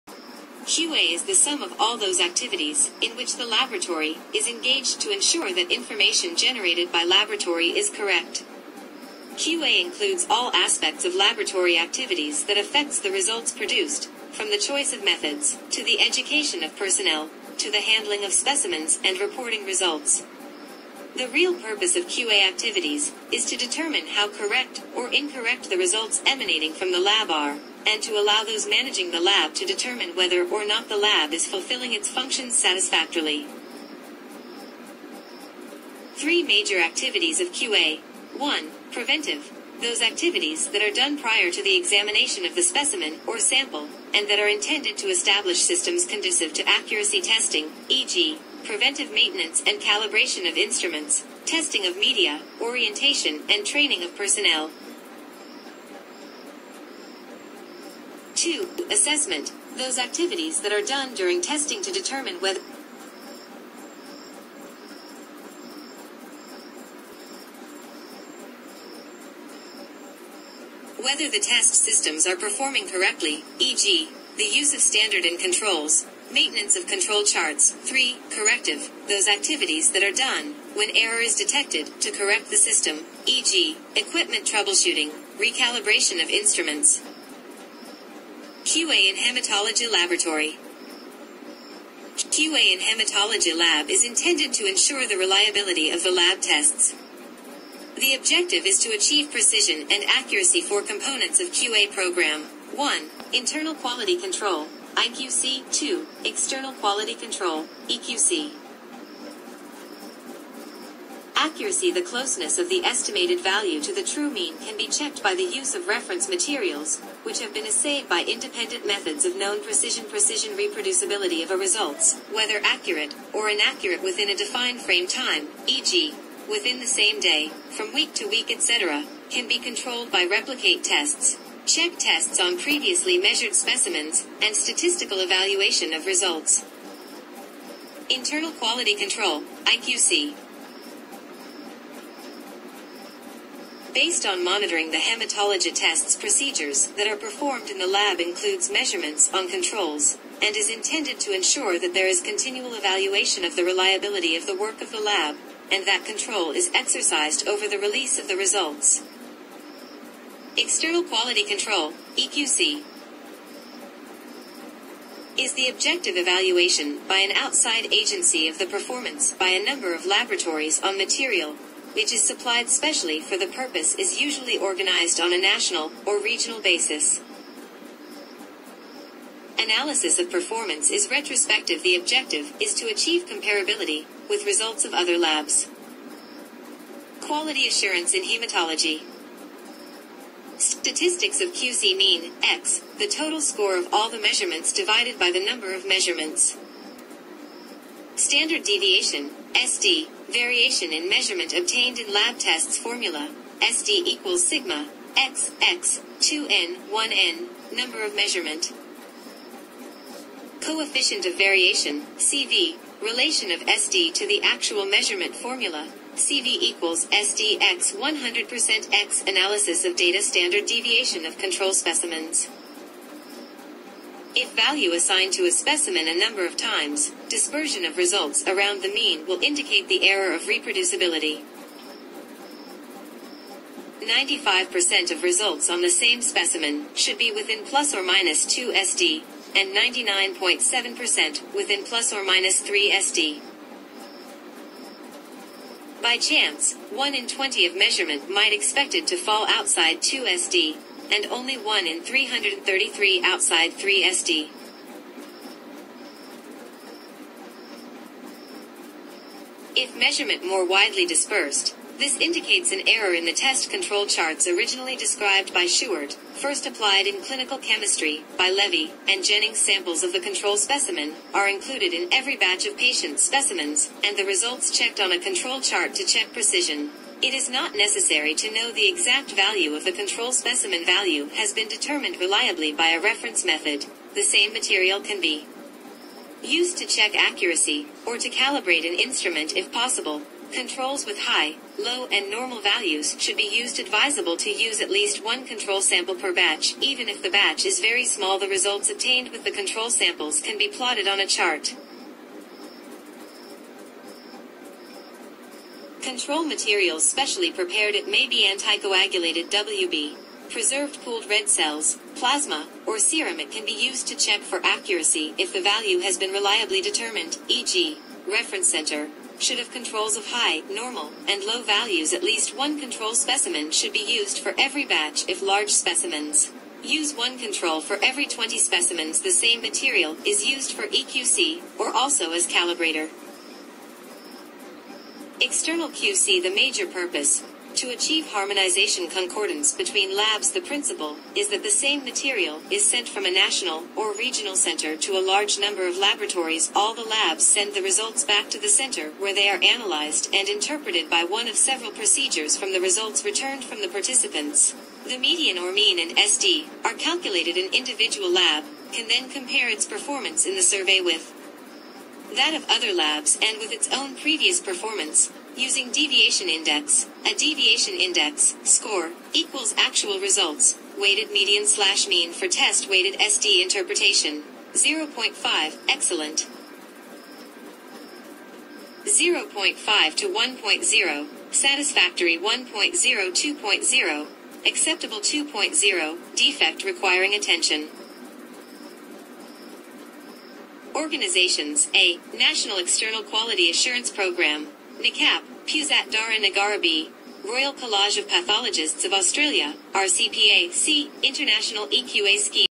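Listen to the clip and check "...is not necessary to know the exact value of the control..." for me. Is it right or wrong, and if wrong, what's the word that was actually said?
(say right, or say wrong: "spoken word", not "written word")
right.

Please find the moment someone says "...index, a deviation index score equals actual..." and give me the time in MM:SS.
06:06.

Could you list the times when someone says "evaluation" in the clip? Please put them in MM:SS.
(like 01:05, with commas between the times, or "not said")
02:15, 02:32, 02:46.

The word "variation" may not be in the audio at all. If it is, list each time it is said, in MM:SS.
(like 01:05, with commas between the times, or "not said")
03:20, 03:31.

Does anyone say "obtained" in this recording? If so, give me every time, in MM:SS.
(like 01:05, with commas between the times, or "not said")
03:21, 04:58.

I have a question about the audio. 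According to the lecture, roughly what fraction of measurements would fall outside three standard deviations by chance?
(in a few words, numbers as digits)
1 in 333.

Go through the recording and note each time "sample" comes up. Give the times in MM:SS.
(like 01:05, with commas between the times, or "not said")
00:43, 04:29, 04:55, 04:59.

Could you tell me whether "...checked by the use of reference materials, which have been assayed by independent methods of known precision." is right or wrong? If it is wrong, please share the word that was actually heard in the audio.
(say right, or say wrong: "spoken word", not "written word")
right.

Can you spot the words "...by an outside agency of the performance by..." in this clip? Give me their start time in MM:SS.
02:47.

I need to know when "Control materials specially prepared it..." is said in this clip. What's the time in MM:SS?
05:06.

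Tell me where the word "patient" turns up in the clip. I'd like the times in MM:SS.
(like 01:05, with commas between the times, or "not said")
04:32.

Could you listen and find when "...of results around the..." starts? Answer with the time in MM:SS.
03:47.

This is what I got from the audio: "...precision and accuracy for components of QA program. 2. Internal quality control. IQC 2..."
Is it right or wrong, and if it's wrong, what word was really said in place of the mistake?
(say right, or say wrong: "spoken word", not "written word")
wrong: "1", not "2".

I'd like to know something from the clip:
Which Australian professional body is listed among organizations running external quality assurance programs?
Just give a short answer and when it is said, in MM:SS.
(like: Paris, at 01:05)
Royal College of Pathologists of Australia, at 06:37.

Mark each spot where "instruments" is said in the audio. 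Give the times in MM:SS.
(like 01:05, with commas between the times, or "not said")
00:50, 01:26, 04:48.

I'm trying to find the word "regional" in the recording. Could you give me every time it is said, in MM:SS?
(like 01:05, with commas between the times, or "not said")
02:56, 05:44.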